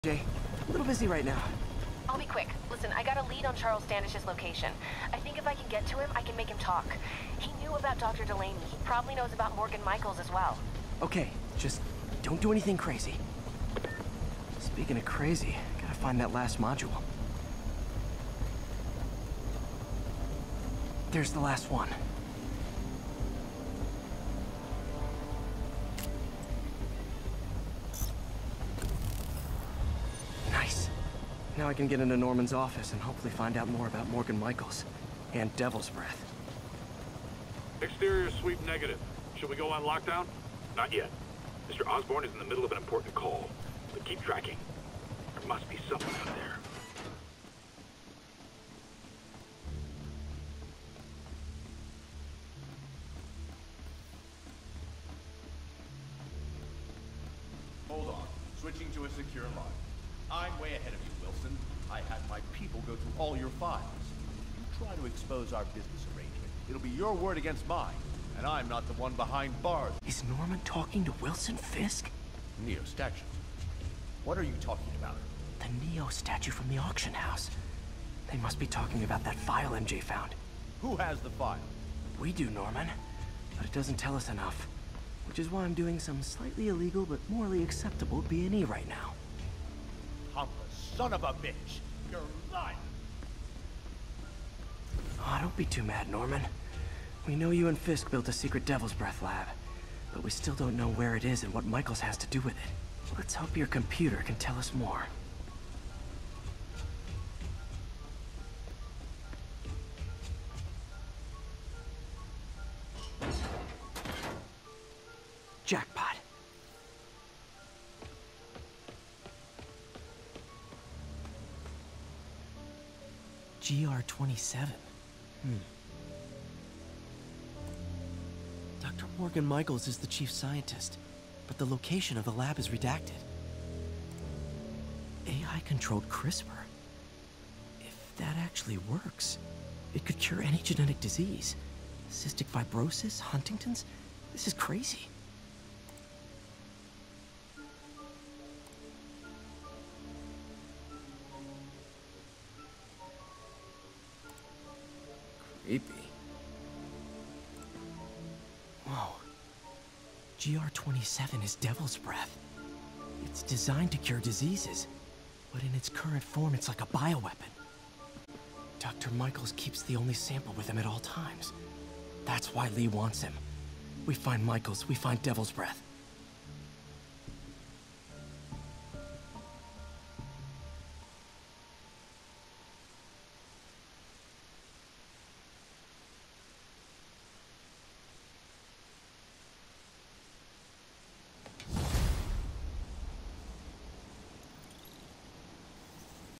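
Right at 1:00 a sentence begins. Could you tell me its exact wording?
I'm way ahead of you, Wilson go through all your files.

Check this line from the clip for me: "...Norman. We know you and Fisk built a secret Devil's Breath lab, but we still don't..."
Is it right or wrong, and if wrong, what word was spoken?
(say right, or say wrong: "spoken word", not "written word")
right.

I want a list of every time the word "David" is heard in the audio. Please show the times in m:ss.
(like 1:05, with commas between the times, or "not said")
not said.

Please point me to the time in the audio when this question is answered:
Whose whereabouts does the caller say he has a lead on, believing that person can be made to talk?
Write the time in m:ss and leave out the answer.
0:03.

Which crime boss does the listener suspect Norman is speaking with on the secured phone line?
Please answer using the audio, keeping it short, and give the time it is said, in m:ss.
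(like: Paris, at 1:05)
Wilson Fisk, at 1:11.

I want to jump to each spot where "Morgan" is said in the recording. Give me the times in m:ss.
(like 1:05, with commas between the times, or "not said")
0:09, 0:34, 2:09.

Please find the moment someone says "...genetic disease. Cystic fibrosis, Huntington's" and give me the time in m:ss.
2:20.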